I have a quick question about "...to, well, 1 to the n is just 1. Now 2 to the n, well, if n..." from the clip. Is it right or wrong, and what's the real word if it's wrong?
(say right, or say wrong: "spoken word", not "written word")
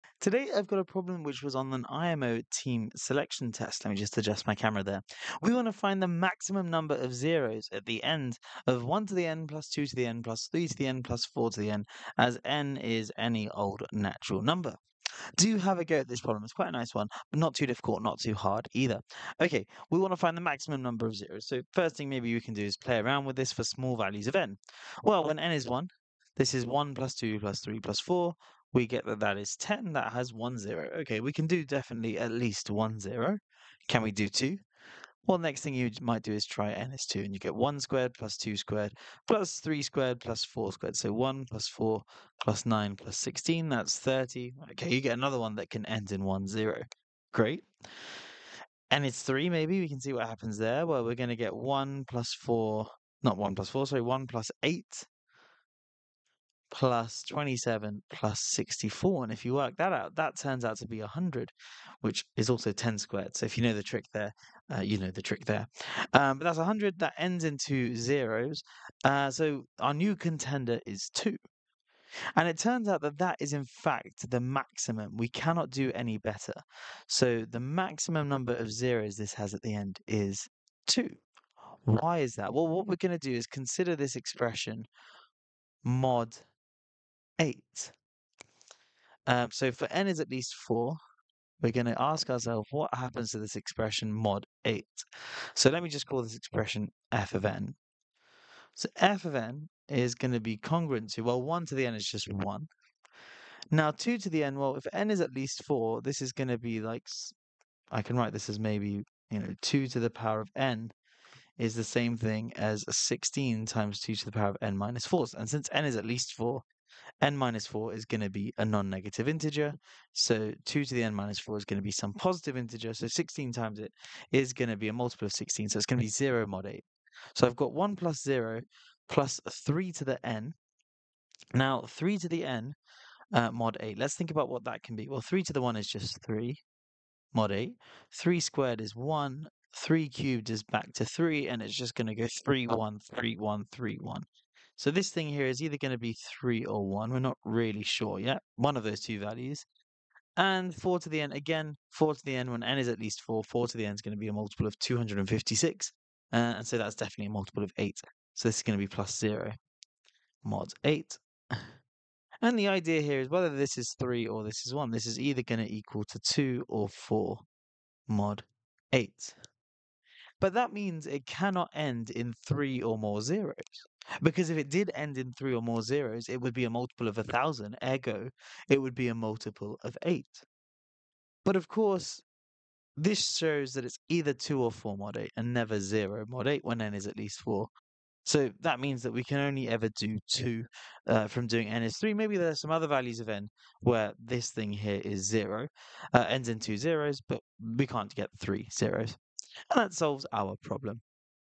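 right.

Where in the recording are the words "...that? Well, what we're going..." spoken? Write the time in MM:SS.
01:22.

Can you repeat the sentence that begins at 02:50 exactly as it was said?
But that means it cannot end in 3 or more zeros.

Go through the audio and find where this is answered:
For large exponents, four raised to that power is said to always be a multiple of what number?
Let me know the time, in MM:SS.
02:34.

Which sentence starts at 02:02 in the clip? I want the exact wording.
So 16 times it is going to be a multiple of 16.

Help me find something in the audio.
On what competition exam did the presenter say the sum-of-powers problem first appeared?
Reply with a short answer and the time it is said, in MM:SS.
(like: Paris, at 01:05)
IMO team selection test, at 00:01.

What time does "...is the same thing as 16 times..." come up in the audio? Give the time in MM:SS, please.
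01:51.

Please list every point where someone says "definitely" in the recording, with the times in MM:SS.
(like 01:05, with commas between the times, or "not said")
00:31, 02:36.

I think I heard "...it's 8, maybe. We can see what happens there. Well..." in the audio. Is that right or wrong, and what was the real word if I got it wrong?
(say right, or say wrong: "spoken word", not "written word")
wrong: "3", not "8".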